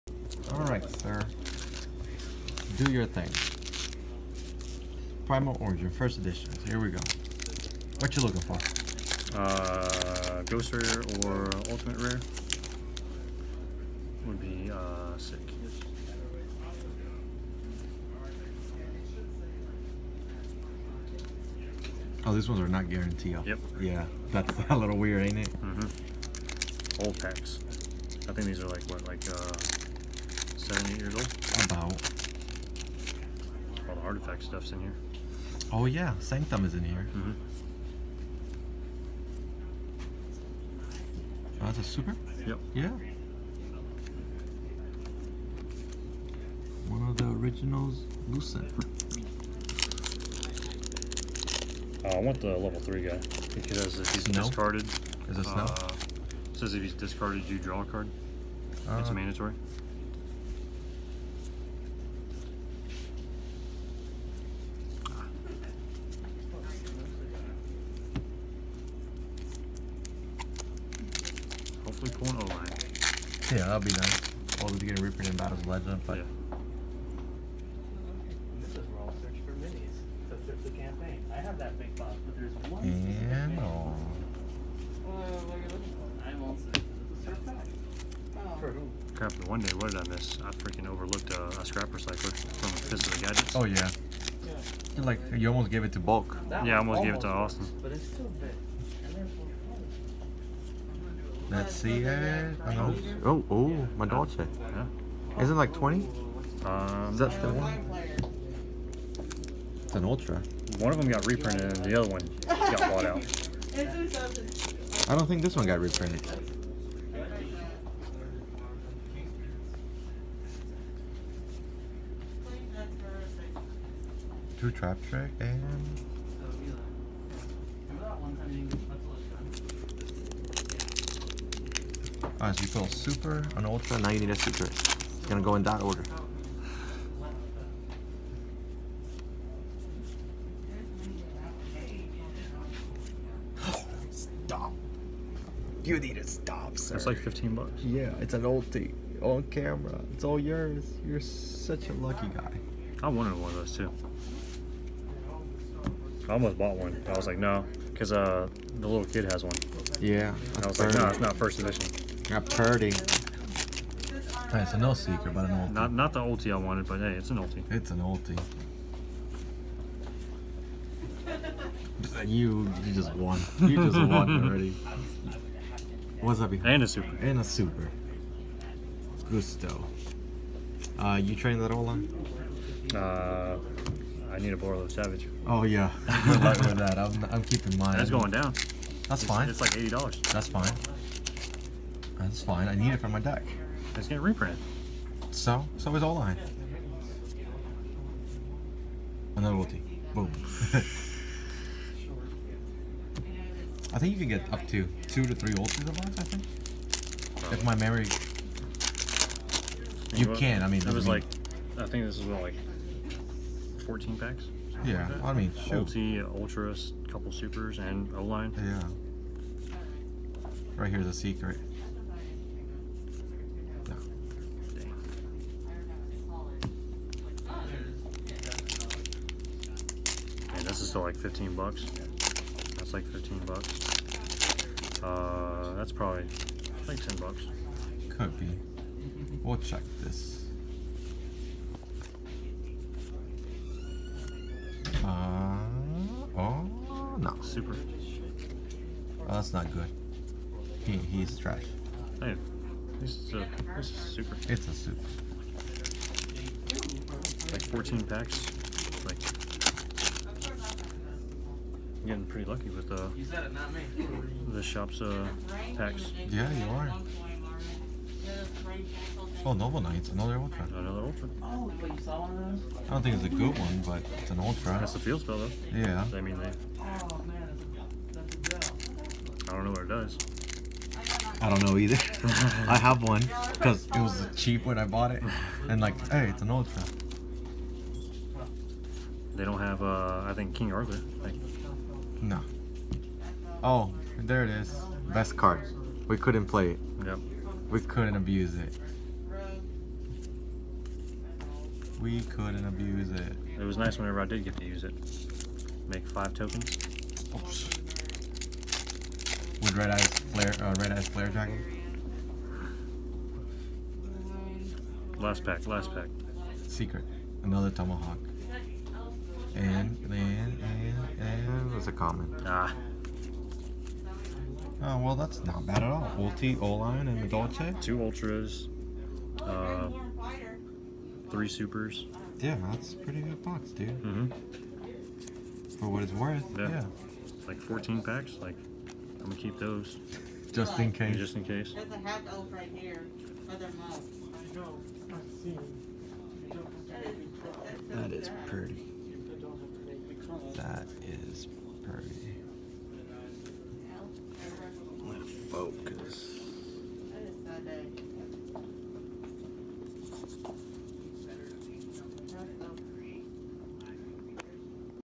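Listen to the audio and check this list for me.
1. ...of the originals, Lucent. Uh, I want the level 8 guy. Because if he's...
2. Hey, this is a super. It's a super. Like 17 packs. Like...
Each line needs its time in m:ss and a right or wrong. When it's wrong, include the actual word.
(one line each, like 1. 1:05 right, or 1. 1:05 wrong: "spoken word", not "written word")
1. 0:47 wrong: "3", not "8"
2. 4:12 wrong: "14", not "17".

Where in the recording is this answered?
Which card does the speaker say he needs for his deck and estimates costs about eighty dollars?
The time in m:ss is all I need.
3:04.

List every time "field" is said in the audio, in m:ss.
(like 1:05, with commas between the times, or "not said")
4:34.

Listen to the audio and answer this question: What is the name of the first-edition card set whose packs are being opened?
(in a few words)
Primal Origin.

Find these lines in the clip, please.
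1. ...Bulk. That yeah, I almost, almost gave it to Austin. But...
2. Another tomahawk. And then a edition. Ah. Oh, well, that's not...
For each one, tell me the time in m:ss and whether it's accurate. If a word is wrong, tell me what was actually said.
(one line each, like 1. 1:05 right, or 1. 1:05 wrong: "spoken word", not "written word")
1. 1:35 right
2. 5:17 wrong: "common", not "edition".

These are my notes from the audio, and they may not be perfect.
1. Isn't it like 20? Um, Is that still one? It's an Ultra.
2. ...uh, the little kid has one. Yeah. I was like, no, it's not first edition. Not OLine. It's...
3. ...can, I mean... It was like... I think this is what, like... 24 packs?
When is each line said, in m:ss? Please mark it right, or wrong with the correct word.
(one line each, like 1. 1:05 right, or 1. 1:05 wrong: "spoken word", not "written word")
1. 1:45 right
2. 2:38 wrong: "Purdy", not "OLine"
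3. 3:30 wrong: "14", not "24".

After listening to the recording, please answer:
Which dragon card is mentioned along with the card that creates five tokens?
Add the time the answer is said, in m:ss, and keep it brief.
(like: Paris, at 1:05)
Red Eyes Flare Dragon, at 5:10.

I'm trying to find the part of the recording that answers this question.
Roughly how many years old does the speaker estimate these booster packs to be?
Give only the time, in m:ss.
0:30.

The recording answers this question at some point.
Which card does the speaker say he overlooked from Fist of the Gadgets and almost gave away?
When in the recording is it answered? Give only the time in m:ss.
1:31.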